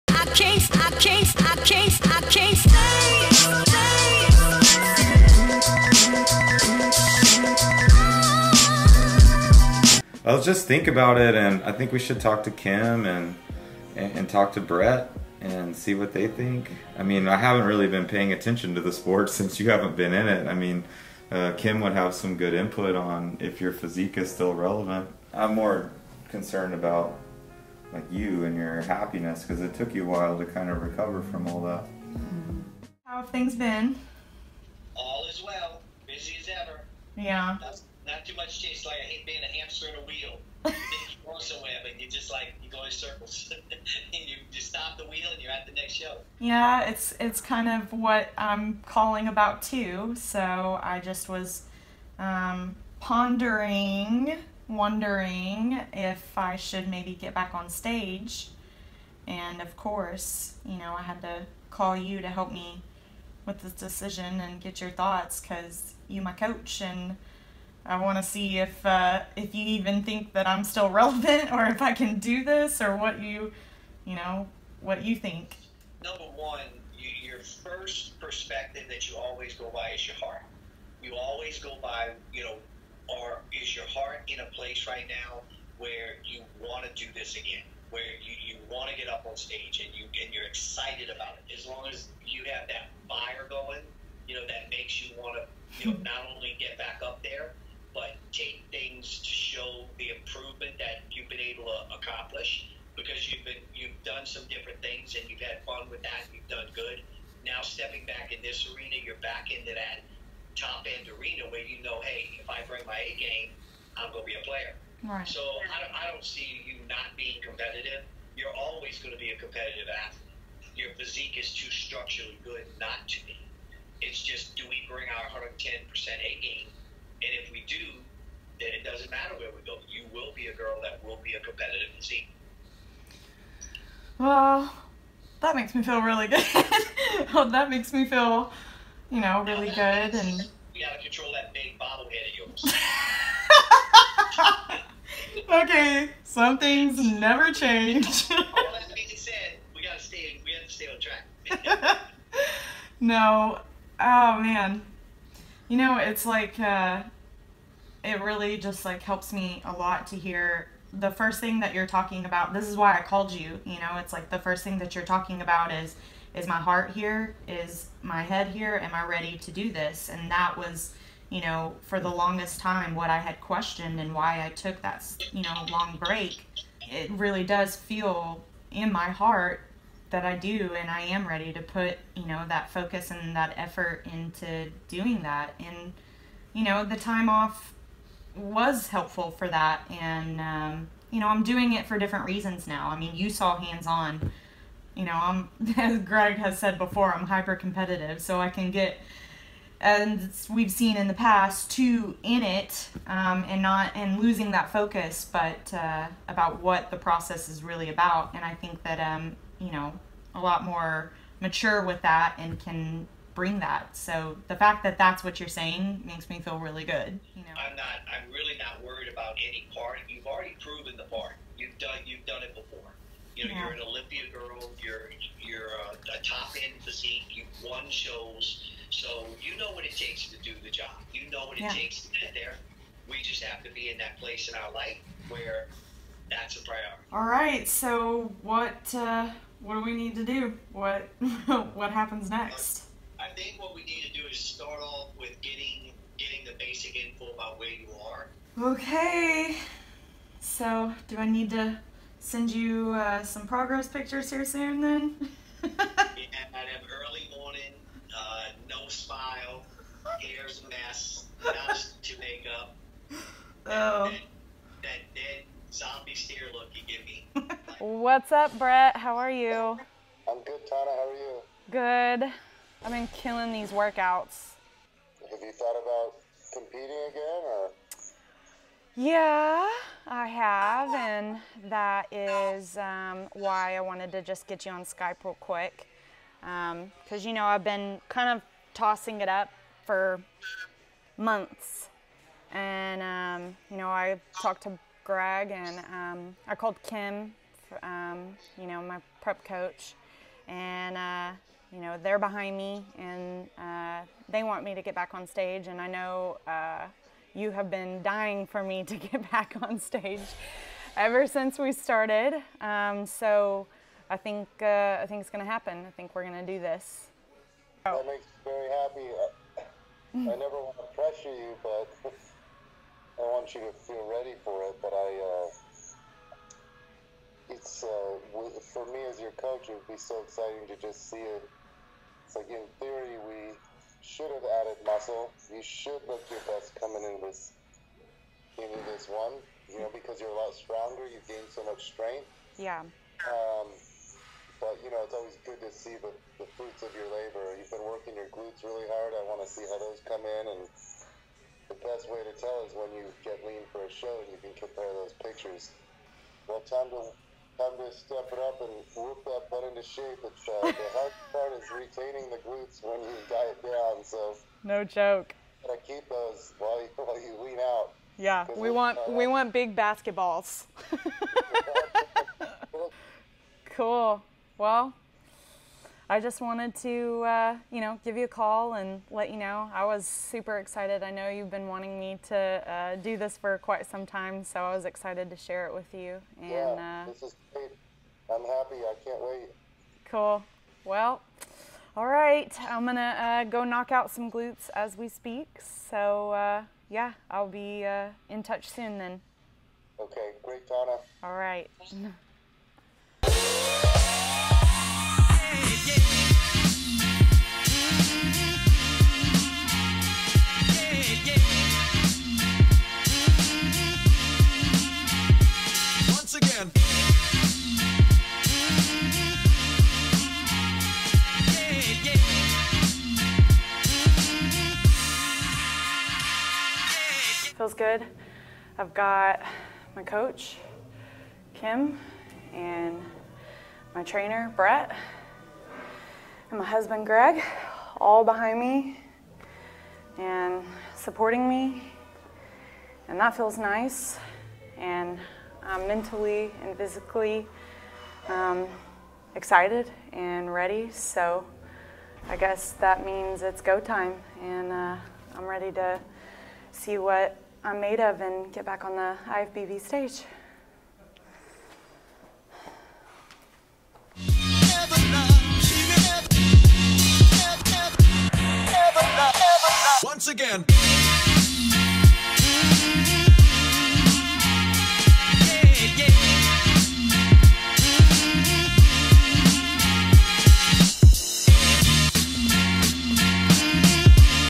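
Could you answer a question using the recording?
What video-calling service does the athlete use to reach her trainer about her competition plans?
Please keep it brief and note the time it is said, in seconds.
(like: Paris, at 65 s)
Skype, at 284 s.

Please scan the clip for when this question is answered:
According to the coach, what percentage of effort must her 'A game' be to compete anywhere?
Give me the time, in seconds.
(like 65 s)
125 s.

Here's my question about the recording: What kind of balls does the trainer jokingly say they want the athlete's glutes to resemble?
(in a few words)
basketballs.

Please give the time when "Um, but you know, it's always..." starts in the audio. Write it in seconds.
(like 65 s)
343 s.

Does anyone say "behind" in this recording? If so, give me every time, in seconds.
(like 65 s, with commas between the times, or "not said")
302 s, 438 s.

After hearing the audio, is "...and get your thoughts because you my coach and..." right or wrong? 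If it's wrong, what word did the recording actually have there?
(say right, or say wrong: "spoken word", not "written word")
right.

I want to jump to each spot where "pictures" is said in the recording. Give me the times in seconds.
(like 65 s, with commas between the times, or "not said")
253 s, 355 s.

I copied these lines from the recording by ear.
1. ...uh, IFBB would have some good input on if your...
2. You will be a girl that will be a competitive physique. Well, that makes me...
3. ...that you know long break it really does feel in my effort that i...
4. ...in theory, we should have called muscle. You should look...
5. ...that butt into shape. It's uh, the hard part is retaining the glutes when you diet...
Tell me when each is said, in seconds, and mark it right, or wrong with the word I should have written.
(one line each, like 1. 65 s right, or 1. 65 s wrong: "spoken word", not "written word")
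1. 21 s wrong: "Kim", not "IFBB"
2. 129 s right
3. 174 s wrong: "heart", not "effort"
4. 332 s wrong: "added", not "called"
5. 359 s right.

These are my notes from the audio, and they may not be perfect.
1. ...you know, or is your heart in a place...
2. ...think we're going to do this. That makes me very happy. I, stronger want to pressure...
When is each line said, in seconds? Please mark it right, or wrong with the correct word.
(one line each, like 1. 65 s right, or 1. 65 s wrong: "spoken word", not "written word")
1. 82 s right
2. 315 s wrong: "never", not "stronger".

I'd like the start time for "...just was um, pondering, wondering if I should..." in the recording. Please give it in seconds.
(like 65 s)
50 s.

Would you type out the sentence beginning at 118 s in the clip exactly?
You're always going to be a competitive athlete.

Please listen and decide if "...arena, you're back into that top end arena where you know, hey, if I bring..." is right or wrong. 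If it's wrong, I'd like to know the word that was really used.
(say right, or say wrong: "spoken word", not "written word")
right.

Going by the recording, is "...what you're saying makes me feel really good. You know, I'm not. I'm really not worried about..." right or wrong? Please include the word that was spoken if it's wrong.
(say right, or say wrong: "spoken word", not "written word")
right.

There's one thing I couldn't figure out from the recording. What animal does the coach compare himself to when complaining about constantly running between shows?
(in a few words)
hamster.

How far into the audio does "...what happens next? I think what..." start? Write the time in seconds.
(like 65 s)
241 s.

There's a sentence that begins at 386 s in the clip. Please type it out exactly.
And, yeah, uh, this is great.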